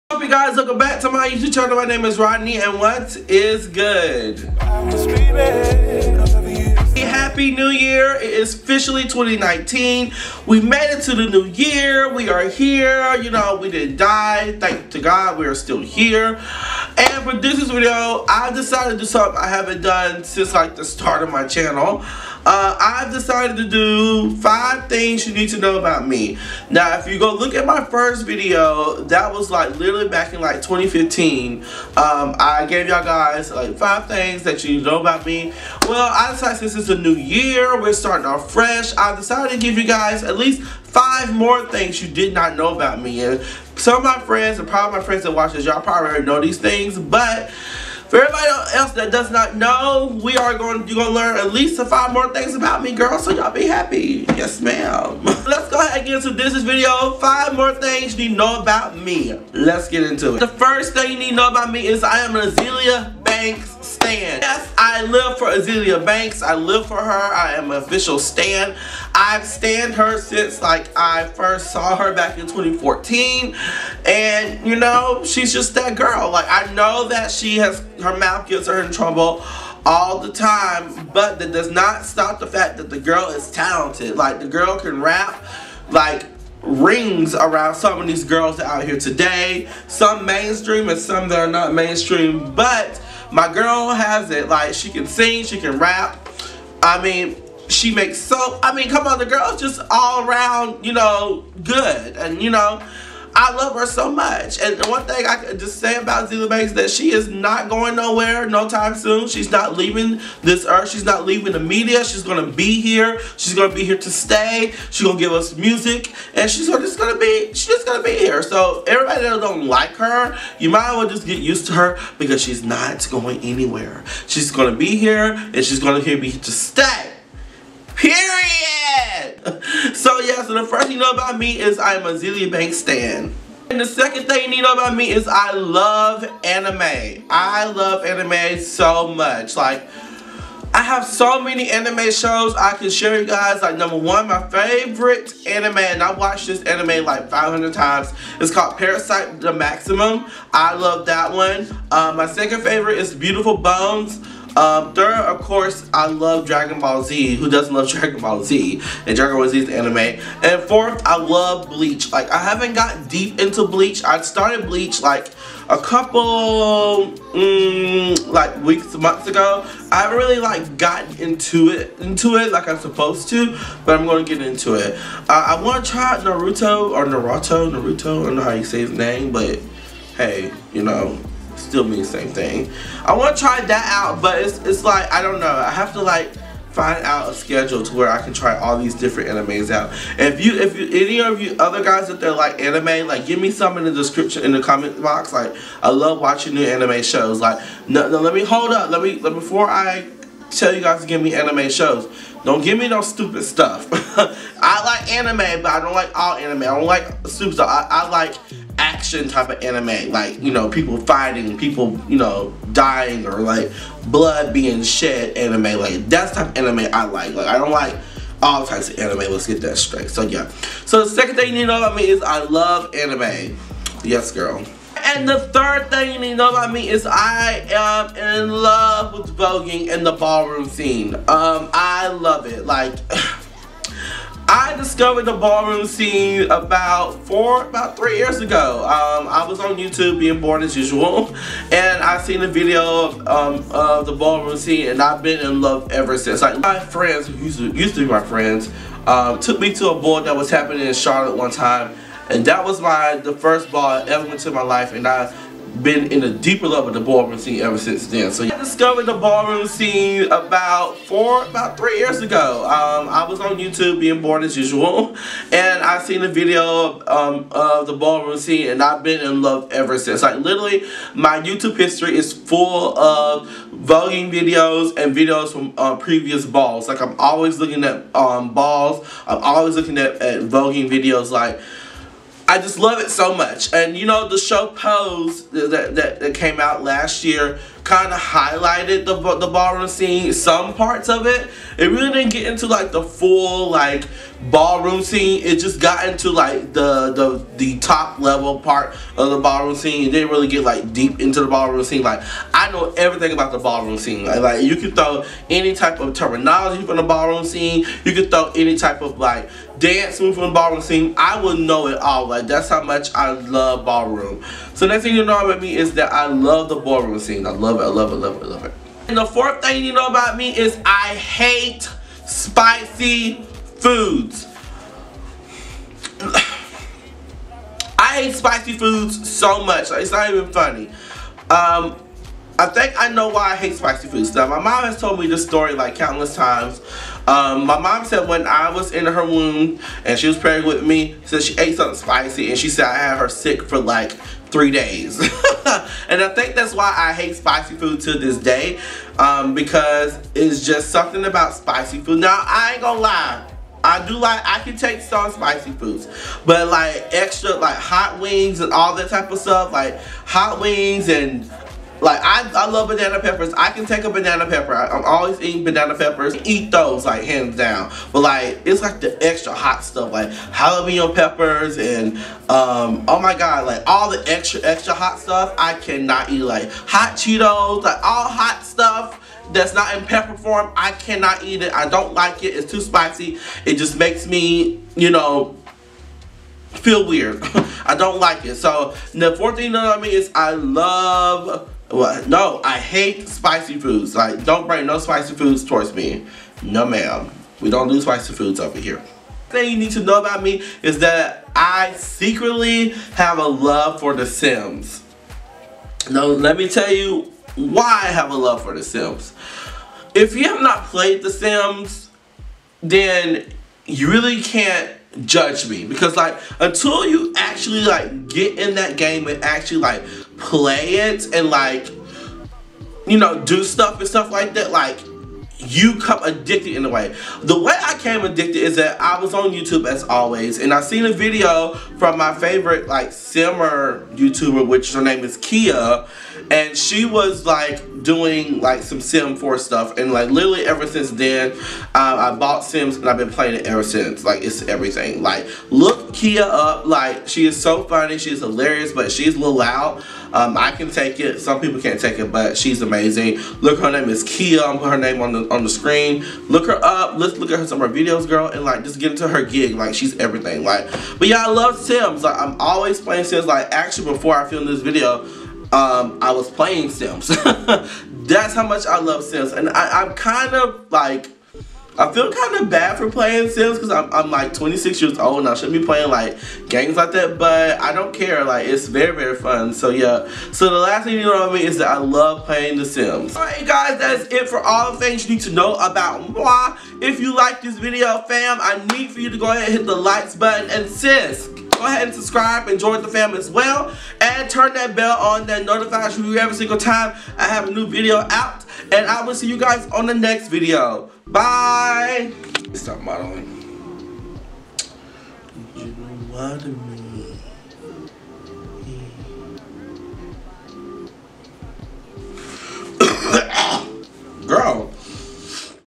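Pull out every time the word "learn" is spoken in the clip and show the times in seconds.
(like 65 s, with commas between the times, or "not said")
51 s.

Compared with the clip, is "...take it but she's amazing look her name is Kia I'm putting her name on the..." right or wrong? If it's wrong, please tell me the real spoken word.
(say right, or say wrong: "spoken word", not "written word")
right.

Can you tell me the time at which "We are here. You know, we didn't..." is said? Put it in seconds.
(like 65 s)
12 s.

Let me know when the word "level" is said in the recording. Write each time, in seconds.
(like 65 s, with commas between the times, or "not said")
298 s.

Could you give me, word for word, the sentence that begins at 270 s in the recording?
Like literally, my YouTube history is full of voguing videos and videos from uh, previous balls.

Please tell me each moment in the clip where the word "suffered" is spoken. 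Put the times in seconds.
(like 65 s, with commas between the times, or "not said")
not said.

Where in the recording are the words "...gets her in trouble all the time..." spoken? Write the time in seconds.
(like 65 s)
78 s.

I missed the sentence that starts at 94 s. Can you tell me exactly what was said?
Like, she can sing, she can rap.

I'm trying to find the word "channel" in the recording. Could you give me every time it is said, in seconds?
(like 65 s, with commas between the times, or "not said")
1 s, 21 s.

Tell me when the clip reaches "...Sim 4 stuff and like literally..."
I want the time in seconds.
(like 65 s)
438 s.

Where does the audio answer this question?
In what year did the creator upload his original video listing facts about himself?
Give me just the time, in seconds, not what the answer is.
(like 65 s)
30 s.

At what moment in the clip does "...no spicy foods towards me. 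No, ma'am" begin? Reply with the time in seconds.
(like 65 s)
394 s.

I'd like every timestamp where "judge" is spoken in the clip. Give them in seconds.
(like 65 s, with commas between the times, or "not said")
415 s.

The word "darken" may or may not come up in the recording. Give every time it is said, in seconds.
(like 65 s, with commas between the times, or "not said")
not said.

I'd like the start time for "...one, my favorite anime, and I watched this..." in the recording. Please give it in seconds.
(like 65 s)
143 s.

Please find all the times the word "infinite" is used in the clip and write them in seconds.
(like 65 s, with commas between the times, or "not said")
not said.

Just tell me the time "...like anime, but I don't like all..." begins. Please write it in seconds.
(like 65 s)
204 s.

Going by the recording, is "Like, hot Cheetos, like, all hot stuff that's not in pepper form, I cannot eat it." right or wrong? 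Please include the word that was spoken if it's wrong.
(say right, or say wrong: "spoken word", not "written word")
right.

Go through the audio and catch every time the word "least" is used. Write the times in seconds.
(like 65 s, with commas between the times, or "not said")
40 s, 51 s.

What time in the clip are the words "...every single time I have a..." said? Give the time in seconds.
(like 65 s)
496 s.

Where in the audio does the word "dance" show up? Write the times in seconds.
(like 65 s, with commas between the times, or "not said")
309 s.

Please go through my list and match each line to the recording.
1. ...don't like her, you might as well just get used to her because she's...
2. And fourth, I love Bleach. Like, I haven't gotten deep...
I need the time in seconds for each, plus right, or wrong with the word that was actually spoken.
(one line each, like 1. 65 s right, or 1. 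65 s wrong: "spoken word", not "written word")
1. 119 s right
2. 160 s right.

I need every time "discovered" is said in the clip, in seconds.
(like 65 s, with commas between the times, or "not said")
234 s, 258 s.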